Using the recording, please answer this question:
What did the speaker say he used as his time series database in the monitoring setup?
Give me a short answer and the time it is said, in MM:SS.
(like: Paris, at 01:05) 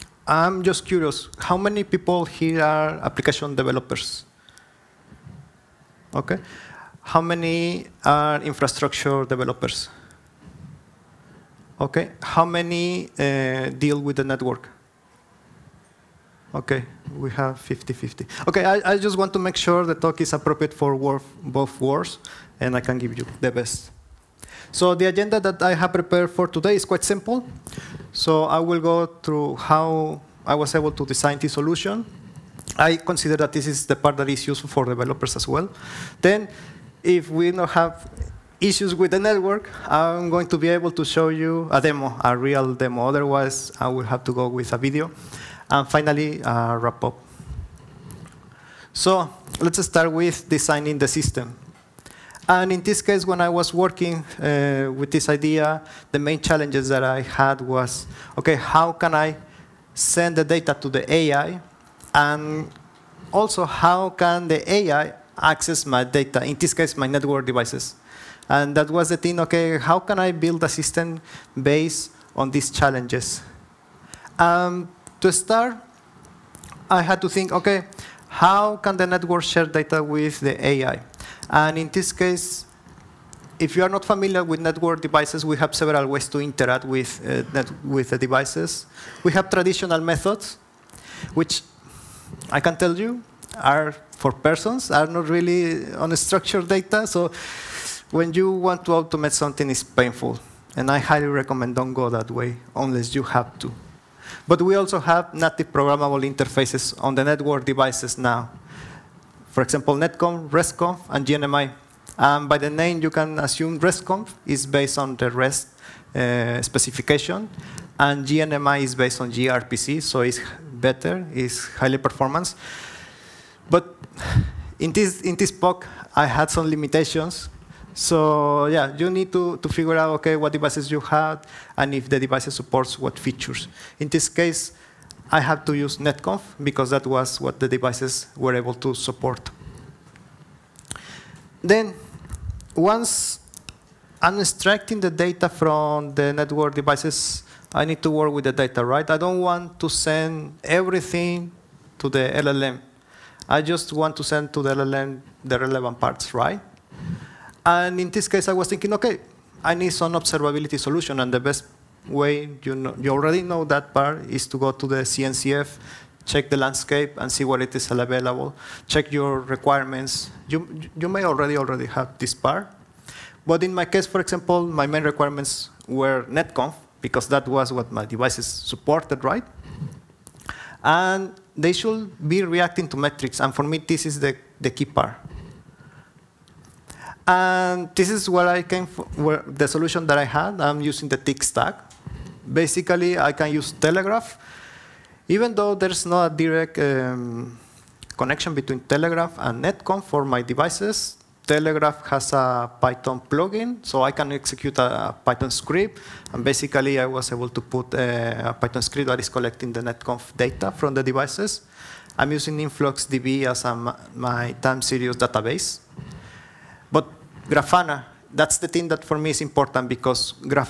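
InfluxDB, at 03:32.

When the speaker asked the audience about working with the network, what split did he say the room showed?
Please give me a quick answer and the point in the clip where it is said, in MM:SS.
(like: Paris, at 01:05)
50-50, at 00:17.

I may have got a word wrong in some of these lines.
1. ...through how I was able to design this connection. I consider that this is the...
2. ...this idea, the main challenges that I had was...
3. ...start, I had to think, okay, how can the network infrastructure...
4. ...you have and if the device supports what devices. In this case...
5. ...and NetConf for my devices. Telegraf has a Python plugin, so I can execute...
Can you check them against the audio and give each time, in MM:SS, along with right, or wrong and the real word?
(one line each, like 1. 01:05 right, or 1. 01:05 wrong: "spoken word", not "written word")
1. 00:29 wrong: "solution", not "connection"
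2. 00:55 right
3. 01:15 wrong: "share", not "infrastructure"
4. 02:10 wrong: "features", not "devices"
5. 03:19 right.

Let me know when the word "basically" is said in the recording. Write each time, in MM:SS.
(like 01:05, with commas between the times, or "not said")
03:12, 03:26.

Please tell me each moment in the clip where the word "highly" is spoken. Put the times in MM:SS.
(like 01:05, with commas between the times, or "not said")
01:40, 02:01.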